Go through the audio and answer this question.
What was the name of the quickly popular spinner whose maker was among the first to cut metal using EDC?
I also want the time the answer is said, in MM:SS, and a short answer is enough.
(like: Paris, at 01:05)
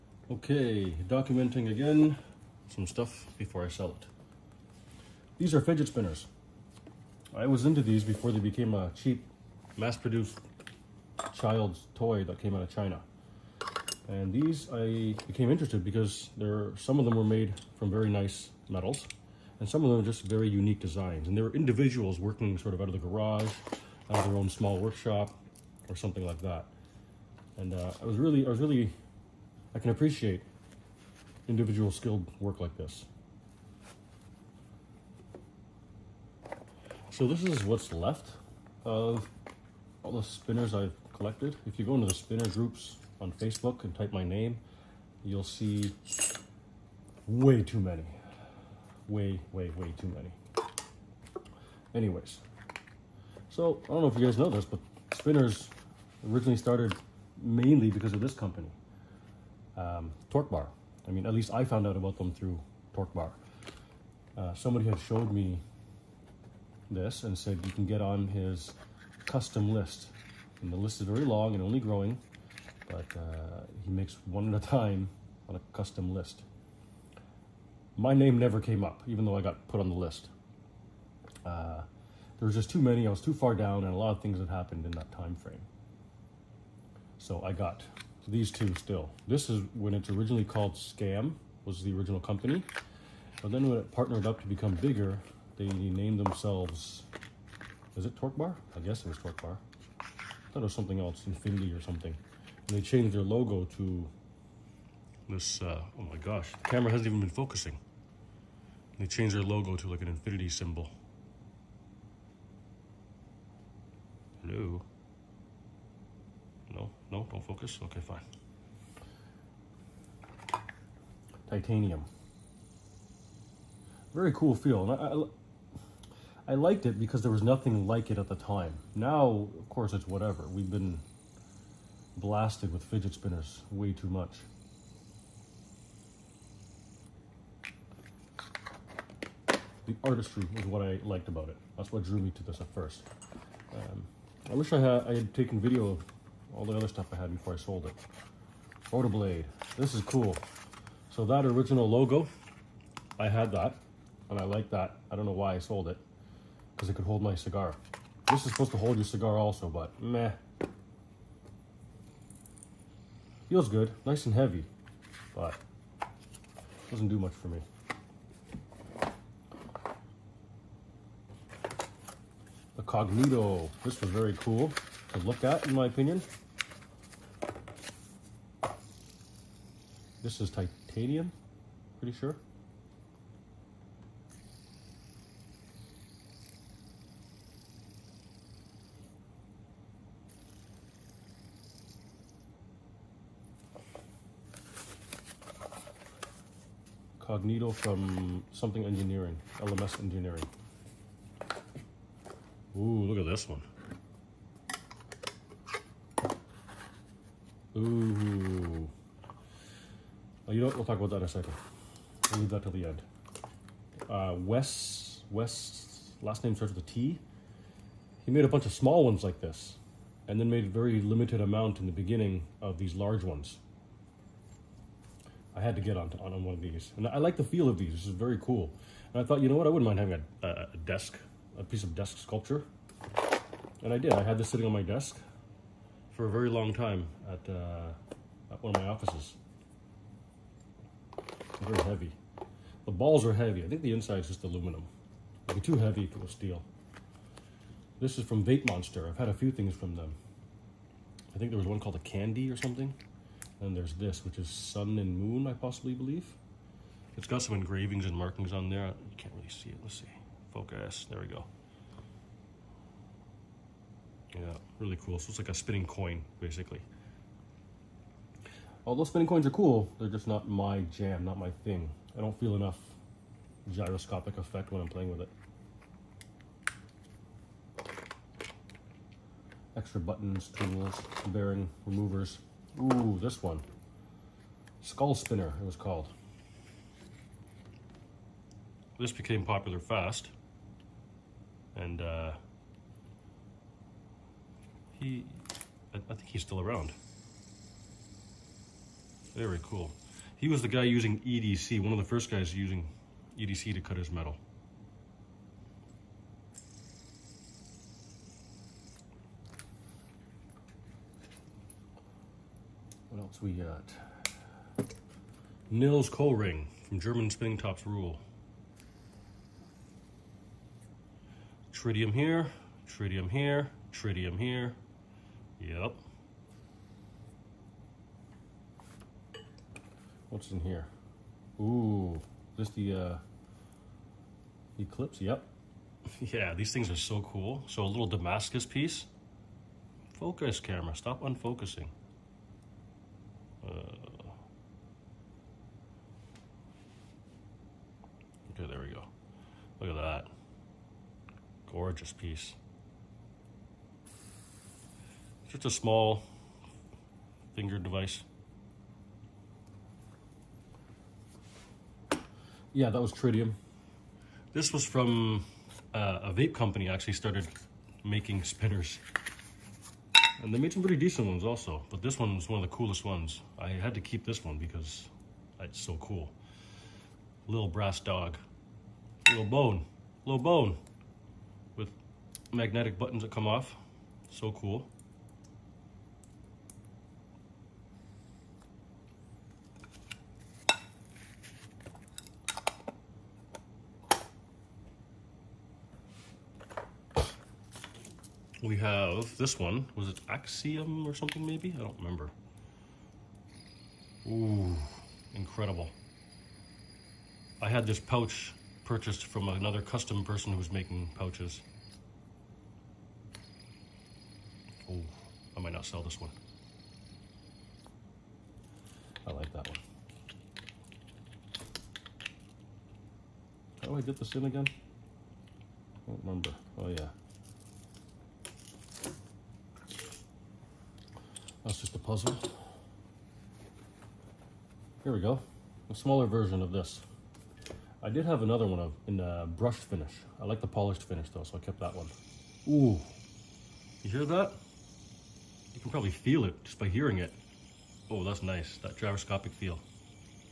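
Skull Spinner, at 04:44.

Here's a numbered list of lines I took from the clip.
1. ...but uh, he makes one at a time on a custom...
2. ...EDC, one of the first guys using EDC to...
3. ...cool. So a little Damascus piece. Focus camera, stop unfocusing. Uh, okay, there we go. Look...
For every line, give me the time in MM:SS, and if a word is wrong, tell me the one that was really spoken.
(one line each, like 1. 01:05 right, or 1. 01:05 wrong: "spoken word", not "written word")
1. 01:12 right
2. 05:01 right
3. 05:37 right.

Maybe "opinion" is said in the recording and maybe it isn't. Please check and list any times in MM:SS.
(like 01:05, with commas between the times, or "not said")
02:55.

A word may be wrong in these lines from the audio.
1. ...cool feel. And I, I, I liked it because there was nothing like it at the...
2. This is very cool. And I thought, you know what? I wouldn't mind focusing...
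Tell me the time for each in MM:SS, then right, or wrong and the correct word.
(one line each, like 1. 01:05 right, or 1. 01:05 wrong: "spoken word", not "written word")
1. 02:04 right
2. 03:47 wrong: "having", not "focusing".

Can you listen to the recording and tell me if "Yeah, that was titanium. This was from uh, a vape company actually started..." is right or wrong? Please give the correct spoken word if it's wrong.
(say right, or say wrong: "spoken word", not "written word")
wrong: "tritium", not "titanium".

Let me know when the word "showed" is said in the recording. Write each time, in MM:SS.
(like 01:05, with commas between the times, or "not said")
01:04.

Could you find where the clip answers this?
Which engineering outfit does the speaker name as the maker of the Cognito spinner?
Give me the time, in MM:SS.
03:19.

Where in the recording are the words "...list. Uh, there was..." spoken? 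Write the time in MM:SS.
01:19.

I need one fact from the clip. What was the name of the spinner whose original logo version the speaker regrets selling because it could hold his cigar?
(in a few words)
Rotoblade.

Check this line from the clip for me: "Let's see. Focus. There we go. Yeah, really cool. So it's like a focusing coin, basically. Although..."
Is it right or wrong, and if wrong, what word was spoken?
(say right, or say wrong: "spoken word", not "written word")
wrong: "spinning", not "focusing".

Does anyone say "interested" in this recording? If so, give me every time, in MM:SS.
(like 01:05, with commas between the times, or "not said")
00:15.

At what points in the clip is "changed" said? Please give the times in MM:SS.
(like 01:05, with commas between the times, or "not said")
01:42, 01:49.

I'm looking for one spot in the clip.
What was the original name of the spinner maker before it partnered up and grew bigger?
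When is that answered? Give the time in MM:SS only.
01:30.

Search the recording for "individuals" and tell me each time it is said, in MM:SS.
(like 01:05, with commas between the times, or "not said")
00:21, 00:31.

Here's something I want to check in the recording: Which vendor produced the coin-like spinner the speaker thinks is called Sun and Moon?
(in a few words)
Vape Monster.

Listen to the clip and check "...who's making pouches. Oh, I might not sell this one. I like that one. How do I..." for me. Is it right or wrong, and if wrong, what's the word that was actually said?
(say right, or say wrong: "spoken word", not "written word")
right.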